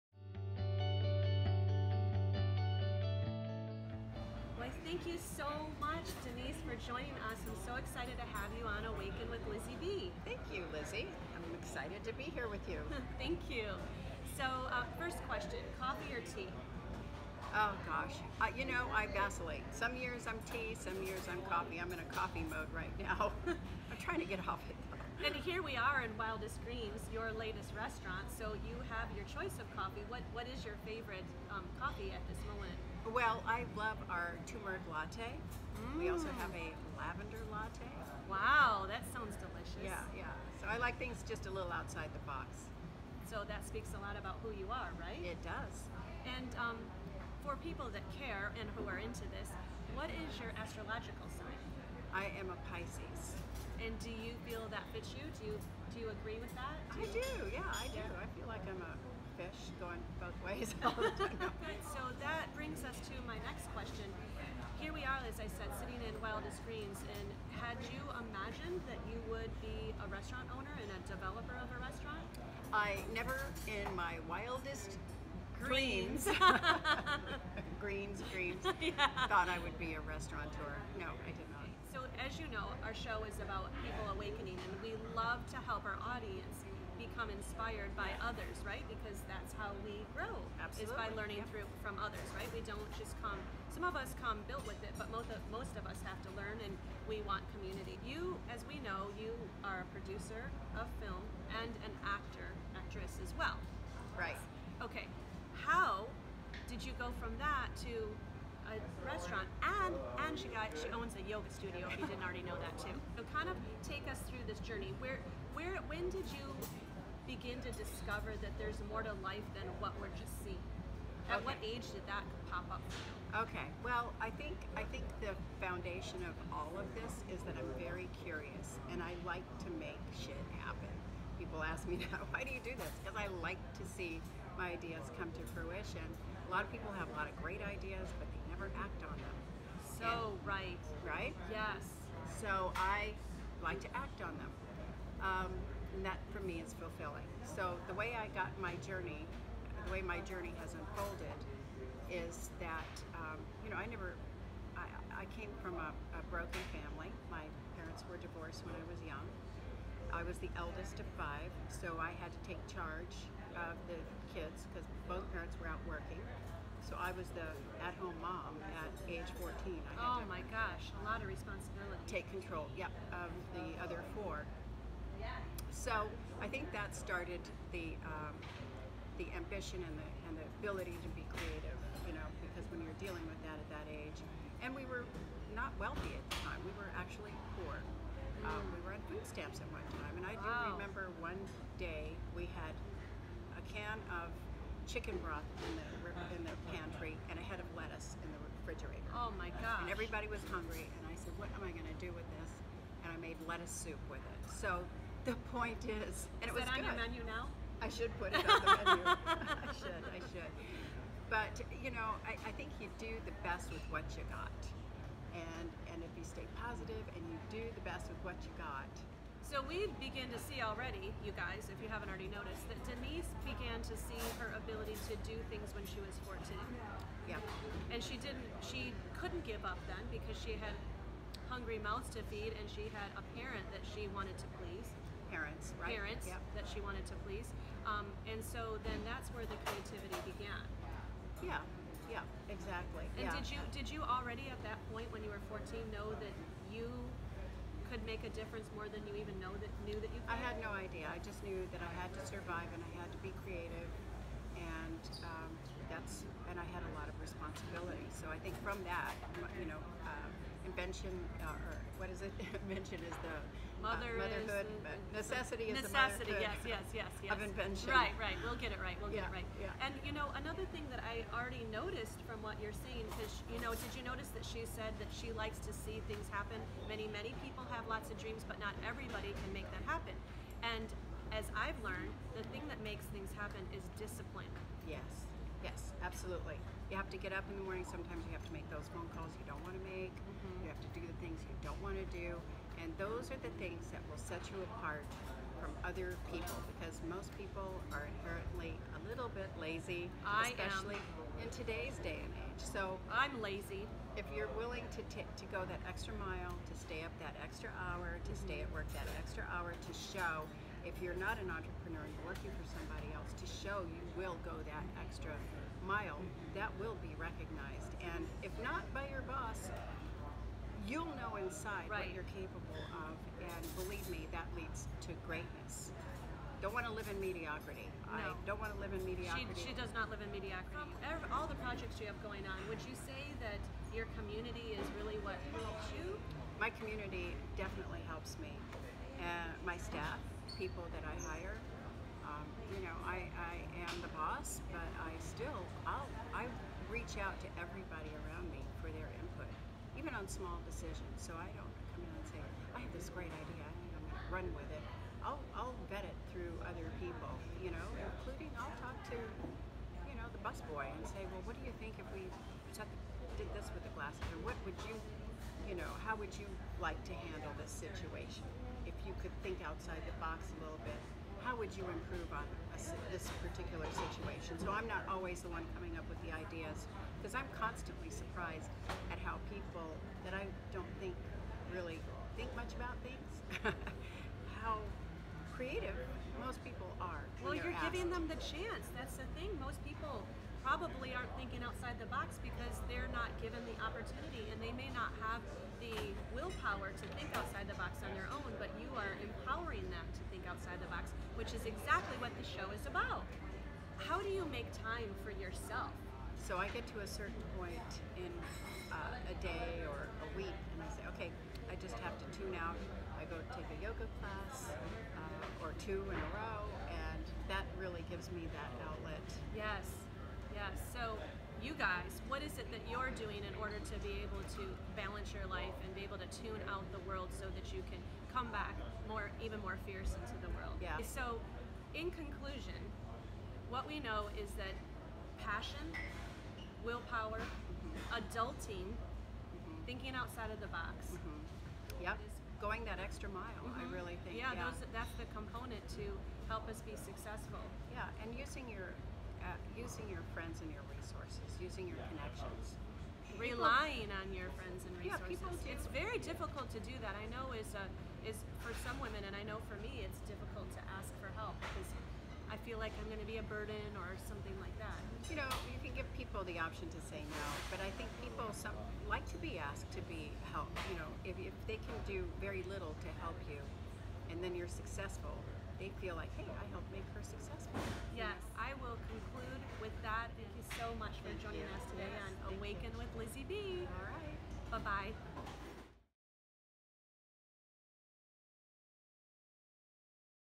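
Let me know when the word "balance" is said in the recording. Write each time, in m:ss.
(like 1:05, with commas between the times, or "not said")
7:04.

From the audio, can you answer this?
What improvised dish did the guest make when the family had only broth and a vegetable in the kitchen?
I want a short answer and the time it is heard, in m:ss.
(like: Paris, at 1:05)
Lettuce soup, at 3:23.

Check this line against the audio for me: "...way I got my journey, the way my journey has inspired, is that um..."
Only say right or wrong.
wrong.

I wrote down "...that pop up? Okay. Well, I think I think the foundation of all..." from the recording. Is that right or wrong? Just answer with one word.
right.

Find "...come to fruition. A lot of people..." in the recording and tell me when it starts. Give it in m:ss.
2:15.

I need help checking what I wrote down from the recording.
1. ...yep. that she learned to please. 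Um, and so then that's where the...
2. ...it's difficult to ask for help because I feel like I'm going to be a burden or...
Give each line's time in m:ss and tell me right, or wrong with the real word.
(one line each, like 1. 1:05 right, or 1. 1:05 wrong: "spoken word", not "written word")
1. 3:56 wrong: "wanted", not "learned"
2. 7:40 right.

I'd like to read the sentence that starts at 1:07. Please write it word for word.
And had you imagined that you would be a restaurant owner and a developer of a restaurant?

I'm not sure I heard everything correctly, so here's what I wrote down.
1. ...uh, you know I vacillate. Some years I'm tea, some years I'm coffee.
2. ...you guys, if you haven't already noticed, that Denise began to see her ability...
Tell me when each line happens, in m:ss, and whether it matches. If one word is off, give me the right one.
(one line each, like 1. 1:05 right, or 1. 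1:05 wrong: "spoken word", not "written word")
1. 0:18 right
2. 3:41 right.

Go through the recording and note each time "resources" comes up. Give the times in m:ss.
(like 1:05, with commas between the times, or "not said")
7:30, 7:35.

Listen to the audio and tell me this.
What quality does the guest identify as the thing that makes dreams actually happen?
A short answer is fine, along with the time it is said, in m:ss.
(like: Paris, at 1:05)
Discipline, at 4:43.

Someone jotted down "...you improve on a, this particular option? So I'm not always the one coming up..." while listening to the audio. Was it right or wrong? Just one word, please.
wrong.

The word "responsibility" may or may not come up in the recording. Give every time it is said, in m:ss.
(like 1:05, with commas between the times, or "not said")
2:51, 4:17.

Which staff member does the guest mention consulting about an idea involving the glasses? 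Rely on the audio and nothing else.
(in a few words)
The busboy.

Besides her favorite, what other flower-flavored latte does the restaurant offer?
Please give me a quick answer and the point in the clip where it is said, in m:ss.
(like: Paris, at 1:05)
Lavender latte, at 0:36.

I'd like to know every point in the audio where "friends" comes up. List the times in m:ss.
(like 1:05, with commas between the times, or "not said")
7:30, 7:34.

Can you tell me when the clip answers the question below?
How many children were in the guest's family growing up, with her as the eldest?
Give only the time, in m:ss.
2:41.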